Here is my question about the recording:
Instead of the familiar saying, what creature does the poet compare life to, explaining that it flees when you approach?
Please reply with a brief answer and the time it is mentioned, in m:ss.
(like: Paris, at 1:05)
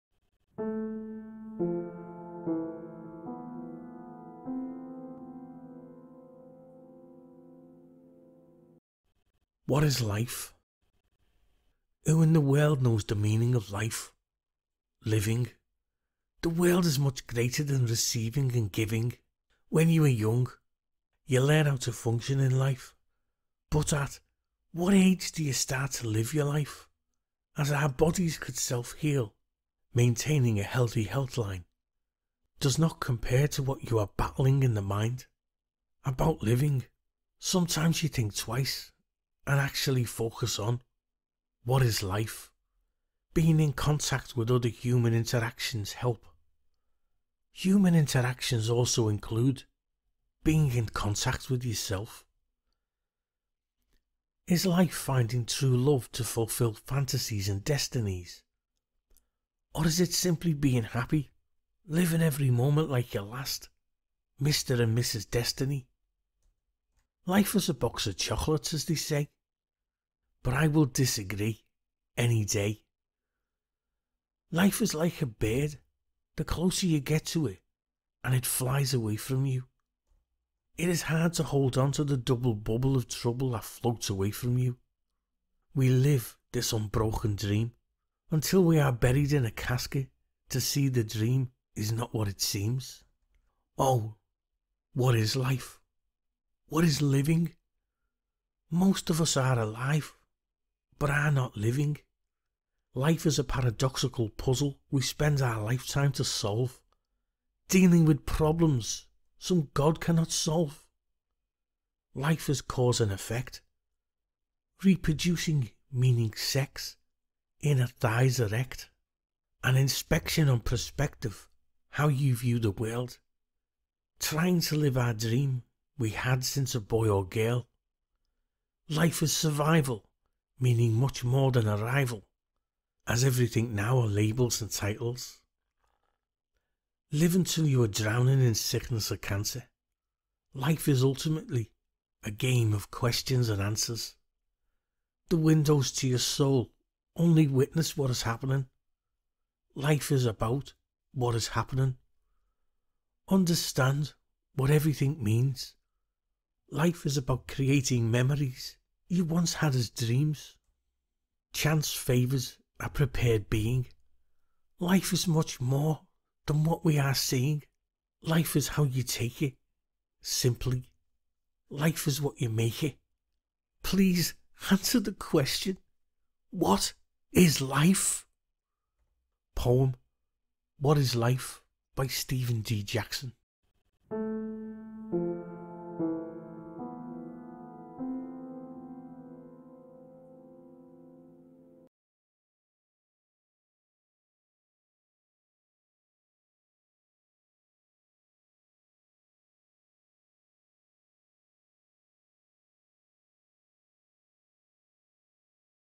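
a bird, at 1:15.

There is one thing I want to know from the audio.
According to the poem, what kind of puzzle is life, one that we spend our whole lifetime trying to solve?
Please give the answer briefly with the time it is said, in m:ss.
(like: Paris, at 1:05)
paradoxical puzzle, at 1:43.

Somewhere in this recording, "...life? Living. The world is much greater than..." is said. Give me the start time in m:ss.
0:13.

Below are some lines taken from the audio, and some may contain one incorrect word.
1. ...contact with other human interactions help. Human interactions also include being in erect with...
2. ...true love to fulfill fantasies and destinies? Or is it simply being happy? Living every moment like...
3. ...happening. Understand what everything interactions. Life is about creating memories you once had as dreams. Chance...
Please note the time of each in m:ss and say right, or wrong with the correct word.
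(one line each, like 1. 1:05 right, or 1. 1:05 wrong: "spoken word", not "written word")
1. 0:43 wrong: "contact", not "erect"
2. 0:55 right
3. 2:31 wrong: "means", not "interactions".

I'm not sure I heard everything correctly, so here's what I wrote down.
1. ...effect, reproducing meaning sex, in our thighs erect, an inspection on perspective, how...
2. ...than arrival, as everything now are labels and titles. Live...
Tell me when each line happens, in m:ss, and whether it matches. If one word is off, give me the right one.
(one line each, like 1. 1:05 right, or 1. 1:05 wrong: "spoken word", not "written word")
1. 1:53 right
2. 2:11 right.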